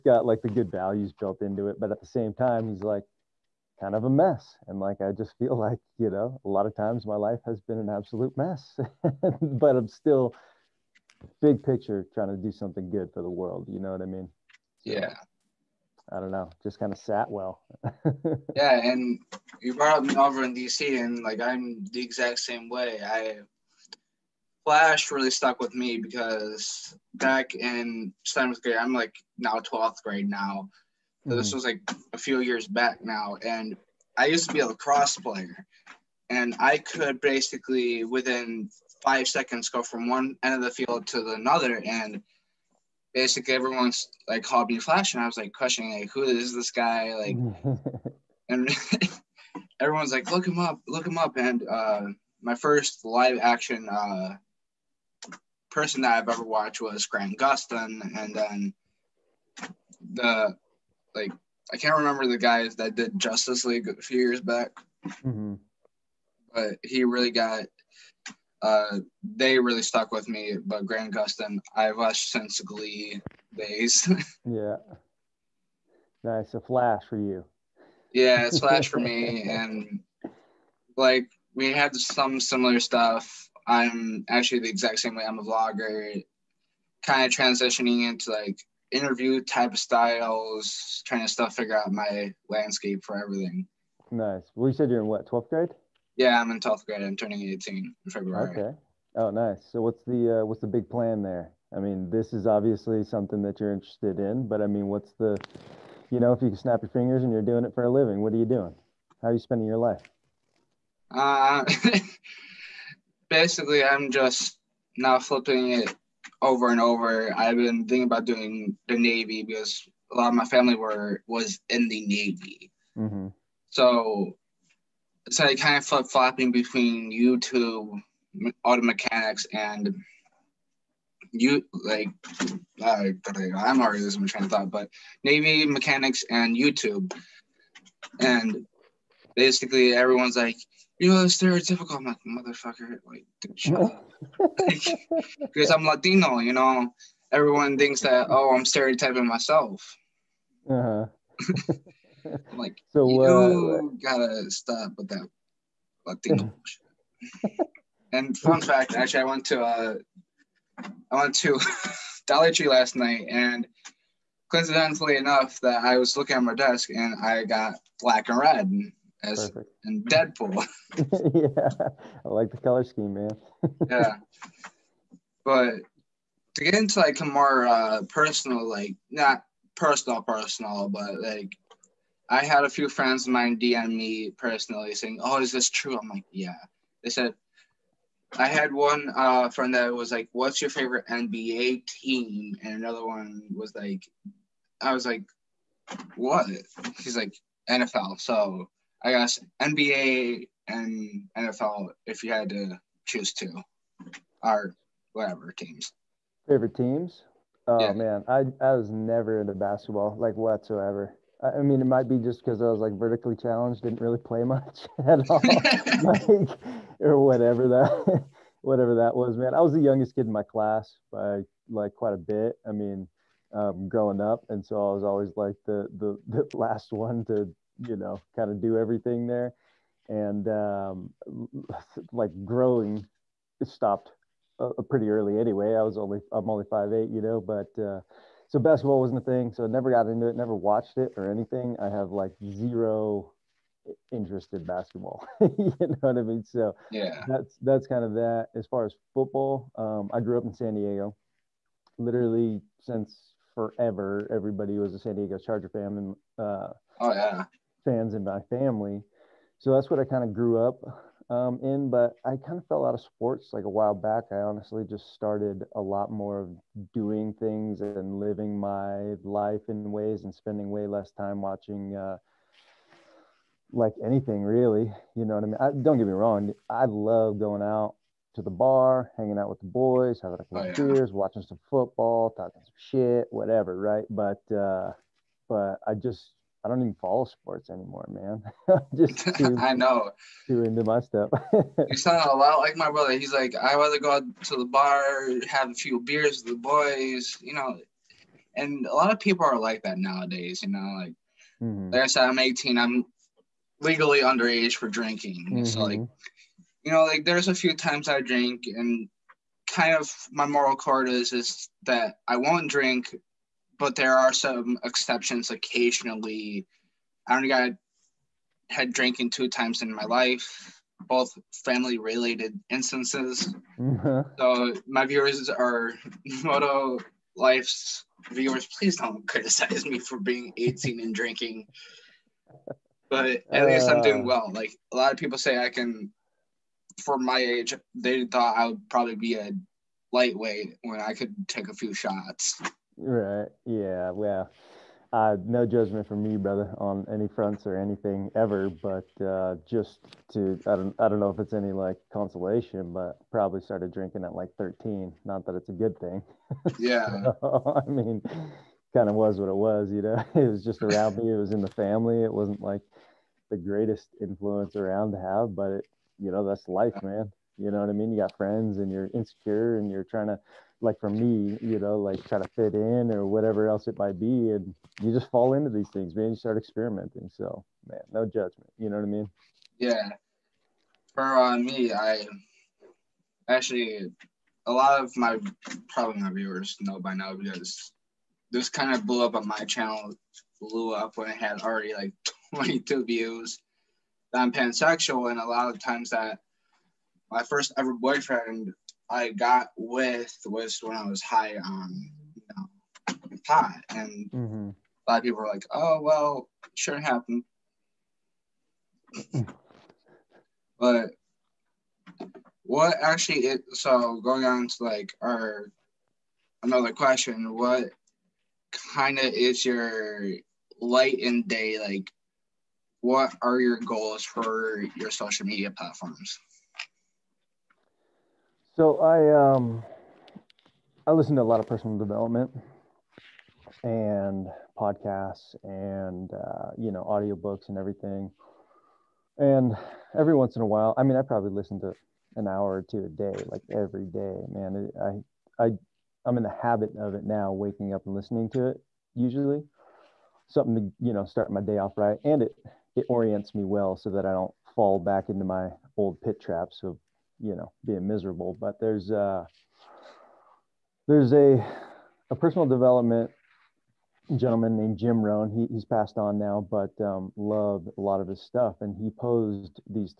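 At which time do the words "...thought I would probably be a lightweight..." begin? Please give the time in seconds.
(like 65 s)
338 s.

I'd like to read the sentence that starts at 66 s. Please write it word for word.
but he really got uh, they really stuck with me.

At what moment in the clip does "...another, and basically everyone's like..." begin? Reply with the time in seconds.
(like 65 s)
41 s.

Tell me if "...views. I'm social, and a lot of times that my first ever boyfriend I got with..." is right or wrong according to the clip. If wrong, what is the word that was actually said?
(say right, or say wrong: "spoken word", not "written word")
wrong: "pansexual", not "social".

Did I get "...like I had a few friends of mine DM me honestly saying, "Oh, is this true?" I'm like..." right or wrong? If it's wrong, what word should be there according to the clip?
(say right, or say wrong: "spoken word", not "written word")
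wrong: "personally", not "honestly".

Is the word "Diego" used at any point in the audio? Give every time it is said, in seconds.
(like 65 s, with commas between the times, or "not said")
250 s, 255 s.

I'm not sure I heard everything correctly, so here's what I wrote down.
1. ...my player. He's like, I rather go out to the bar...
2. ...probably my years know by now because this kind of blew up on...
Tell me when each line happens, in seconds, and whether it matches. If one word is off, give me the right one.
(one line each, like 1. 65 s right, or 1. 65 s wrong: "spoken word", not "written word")
1. 292 s wrong: "brother", not "player"
2. 385 s wrong: "viewers", not "years".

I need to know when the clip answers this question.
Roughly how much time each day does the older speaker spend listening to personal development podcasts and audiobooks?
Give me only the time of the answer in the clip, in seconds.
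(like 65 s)
442 s.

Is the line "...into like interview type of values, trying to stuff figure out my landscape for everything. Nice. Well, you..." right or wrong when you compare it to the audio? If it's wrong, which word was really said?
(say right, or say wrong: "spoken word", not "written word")
wrong: "styles", not "values".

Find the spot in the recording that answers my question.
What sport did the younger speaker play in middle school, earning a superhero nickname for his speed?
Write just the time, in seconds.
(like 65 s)
34 s.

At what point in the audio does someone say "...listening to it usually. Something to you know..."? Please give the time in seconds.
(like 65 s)
448 s.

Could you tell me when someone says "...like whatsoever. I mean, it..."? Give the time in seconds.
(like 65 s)
210 s.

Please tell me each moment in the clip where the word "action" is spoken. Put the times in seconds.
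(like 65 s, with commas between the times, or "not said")
53 s.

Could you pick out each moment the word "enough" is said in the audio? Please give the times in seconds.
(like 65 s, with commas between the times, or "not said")
165 s.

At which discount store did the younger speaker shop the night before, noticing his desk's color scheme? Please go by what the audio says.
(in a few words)
Dollar Tree.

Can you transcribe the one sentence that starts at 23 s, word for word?
I Flash really stuck with me because back in seventh grade, I'm like now 12th grade now.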